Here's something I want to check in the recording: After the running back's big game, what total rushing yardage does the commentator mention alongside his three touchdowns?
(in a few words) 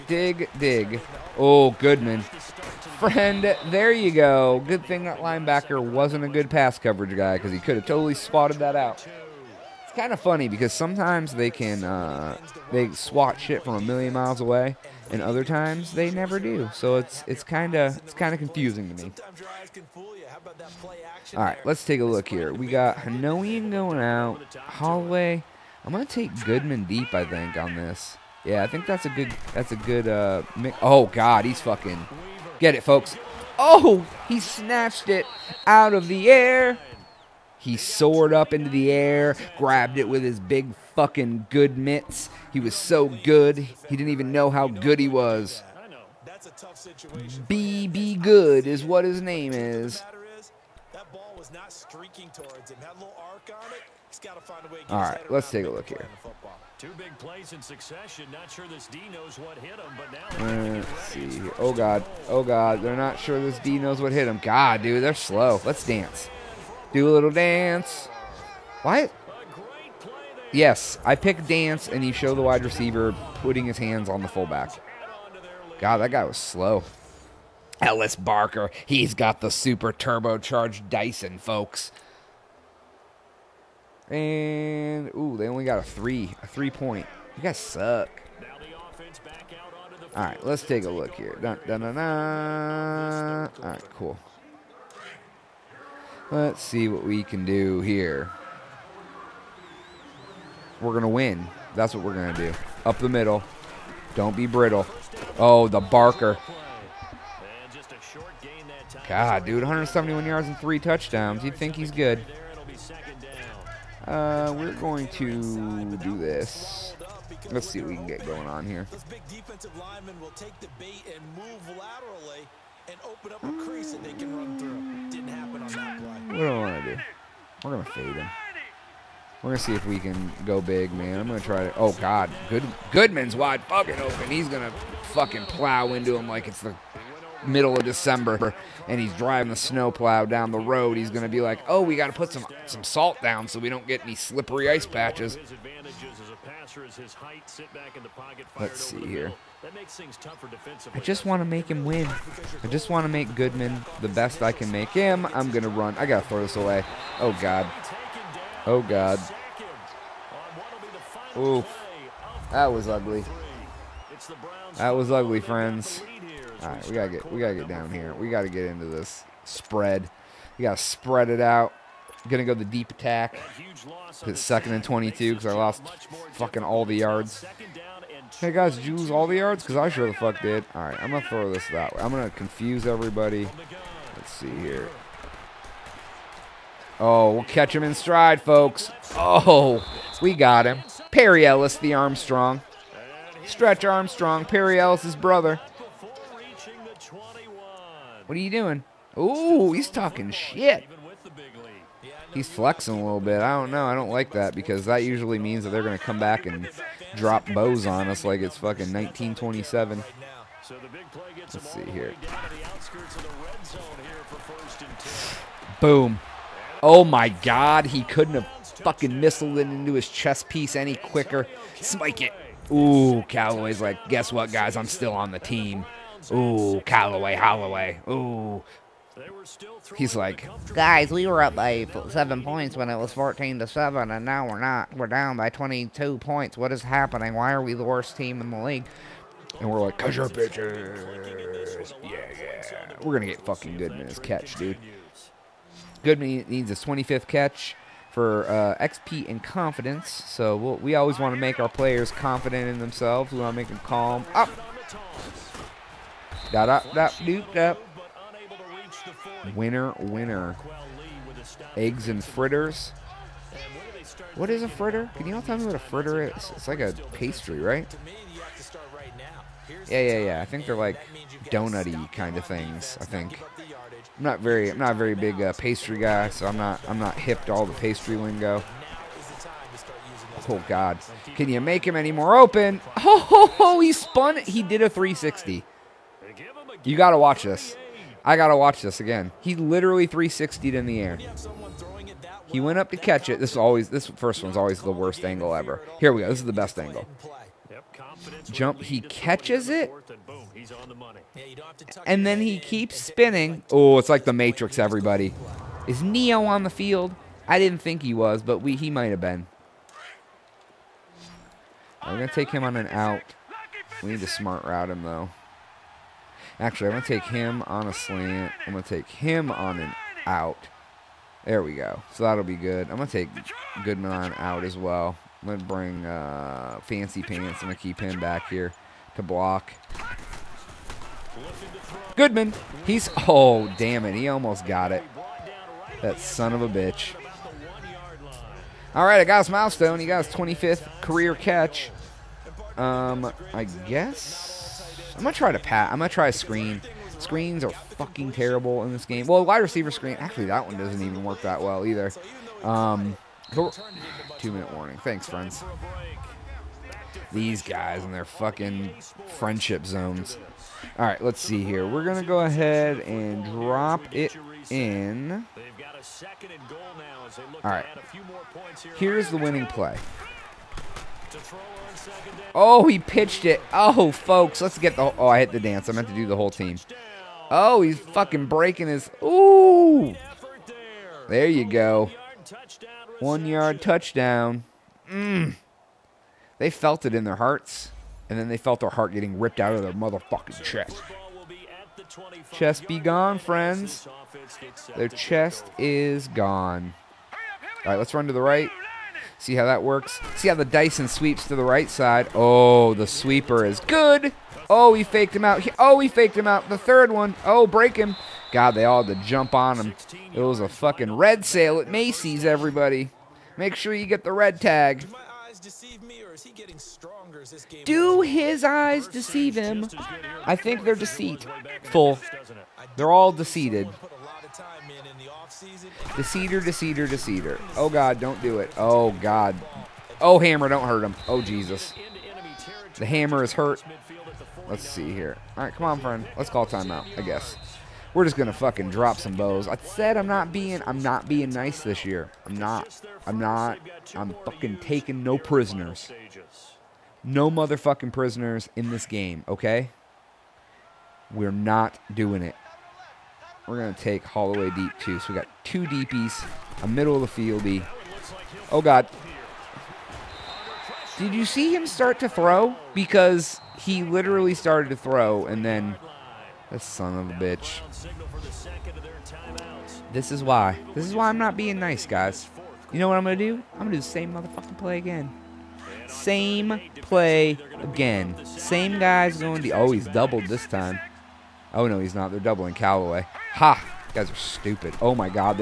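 171 yards.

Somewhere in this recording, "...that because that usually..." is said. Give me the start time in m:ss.
3:24.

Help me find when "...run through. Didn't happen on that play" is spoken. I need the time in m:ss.
2:04.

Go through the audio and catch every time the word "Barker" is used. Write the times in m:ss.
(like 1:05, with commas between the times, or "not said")
1:18, 1:45.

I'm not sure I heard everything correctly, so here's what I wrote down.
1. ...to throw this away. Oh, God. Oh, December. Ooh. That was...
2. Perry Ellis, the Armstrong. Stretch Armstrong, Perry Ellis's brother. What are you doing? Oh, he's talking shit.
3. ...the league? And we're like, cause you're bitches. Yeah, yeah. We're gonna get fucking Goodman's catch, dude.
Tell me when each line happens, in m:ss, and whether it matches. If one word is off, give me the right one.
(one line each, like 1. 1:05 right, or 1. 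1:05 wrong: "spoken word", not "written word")
1. 2:36 wrong: "God", not "December"
2. 3:11 right
3. 3:58 right.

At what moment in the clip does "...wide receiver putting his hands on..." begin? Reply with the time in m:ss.
1:12.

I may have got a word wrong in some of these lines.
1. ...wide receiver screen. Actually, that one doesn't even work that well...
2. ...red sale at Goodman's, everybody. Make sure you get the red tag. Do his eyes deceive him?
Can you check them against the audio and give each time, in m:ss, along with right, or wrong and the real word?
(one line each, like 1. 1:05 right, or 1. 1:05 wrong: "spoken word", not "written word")
1. 5:49 right
2. 6:51 wrong: "Macy", not "Goodman".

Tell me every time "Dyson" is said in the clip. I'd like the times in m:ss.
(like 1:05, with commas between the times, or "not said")
1:20, 6:40.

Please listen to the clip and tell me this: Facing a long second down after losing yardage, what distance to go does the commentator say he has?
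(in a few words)
22.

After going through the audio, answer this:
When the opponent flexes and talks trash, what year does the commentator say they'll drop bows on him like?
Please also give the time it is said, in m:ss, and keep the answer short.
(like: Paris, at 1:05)
1927, at 3:28.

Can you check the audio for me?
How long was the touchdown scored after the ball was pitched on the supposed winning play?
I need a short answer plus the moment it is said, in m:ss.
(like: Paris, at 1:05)
1 yard, at 6:23.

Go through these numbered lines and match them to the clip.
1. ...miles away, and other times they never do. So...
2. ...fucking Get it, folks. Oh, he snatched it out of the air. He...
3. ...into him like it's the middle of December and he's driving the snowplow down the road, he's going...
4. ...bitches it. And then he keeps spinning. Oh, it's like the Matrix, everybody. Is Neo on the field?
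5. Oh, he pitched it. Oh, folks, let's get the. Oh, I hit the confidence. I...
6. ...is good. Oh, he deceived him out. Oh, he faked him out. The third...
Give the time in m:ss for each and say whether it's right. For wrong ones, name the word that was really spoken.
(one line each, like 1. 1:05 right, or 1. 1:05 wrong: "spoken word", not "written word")
1. 0:14 right
2. 0:31 right
3. 2:15 right
4. 4:59 wrong: "catches", not "bitches"
5. 6:12 wrong: "dance", not "confidence"
6. 6:43 wrong: "faked", not "deceived".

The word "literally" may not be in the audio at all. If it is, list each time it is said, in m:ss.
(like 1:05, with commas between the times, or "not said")
4:49, 7:44.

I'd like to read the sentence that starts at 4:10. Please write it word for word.
So we'll, we always want to make our players confident in themselves.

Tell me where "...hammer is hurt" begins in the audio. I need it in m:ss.
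7:13.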